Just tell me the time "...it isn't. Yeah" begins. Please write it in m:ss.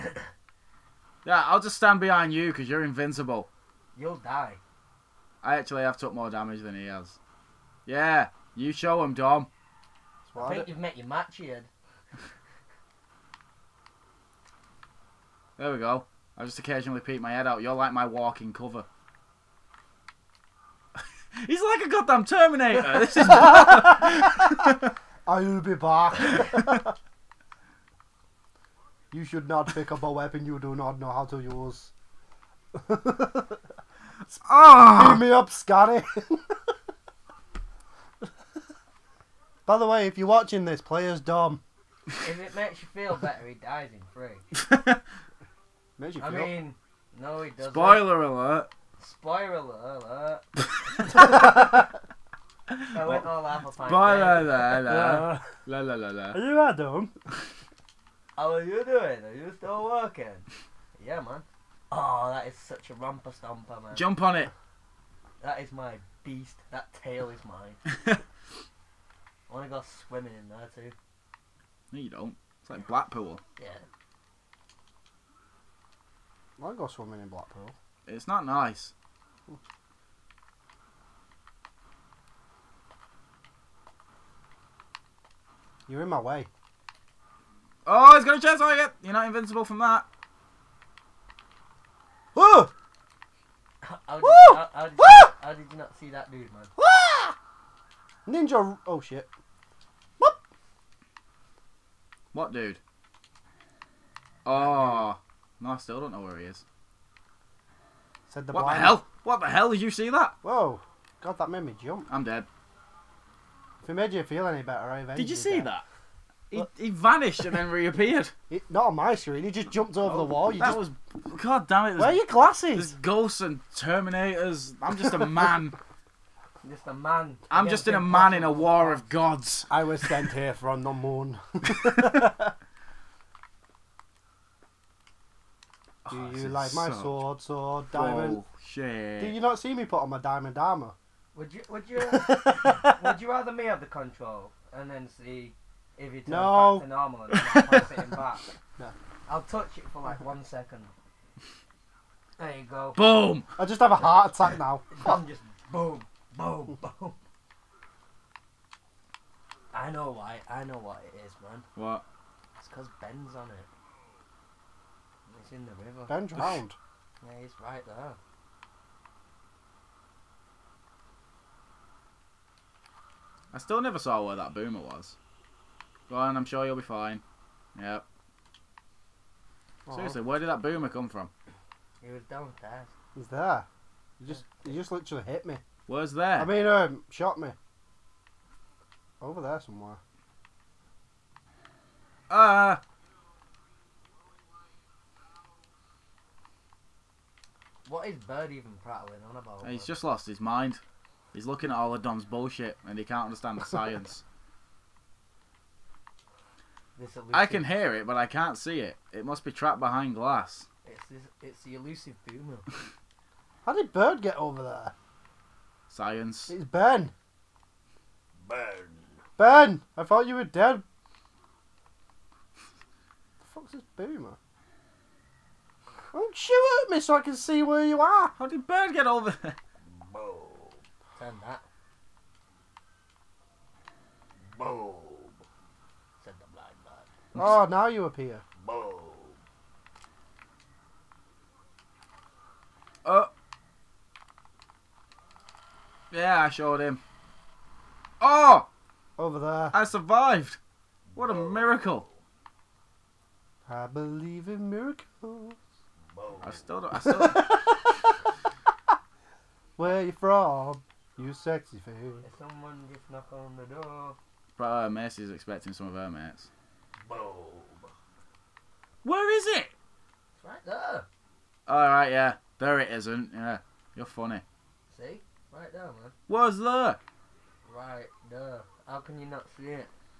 4:32.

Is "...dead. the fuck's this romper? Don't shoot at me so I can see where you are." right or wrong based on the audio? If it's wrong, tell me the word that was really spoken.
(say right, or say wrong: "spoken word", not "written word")
wrong: "boomer", not "romper".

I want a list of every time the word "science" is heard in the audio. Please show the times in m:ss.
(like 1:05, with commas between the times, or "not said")
3:23, 3:35.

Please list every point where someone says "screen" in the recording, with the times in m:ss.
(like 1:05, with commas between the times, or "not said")
1:59.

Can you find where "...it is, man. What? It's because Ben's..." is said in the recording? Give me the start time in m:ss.
2:41.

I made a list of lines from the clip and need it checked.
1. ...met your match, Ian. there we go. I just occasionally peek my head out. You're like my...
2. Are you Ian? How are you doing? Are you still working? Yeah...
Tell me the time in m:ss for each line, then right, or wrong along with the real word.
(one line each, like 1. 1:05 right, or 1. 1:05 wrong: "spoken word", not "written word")
1. 0:10 right
2. 0:56 wrong: "Adam", not "Ian".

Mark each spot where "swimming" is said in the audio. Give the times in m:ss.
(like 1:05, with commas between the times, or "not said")
1:09, 1:16.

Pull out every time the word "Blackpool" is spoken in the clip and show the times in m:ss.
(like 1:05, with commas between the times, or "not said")
1:12, 1:17.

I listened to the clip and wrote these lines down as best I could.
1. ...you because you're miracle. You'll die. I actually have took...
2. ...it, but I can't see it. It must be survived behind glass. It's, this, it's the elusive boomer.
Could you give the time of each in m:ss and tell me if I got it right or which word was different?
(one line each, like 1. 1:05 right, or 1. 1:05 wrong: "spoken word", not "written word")
1. 0:02 wrong: "invincible", not "miracle"
2. 3:27 wrong: "trapped", not "survived".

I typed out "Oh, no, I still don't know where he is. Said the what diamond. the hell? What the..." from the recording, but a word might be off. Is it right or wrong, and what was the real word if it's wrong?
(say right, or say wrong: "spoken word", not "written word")
wrong: "blind", not "diamond".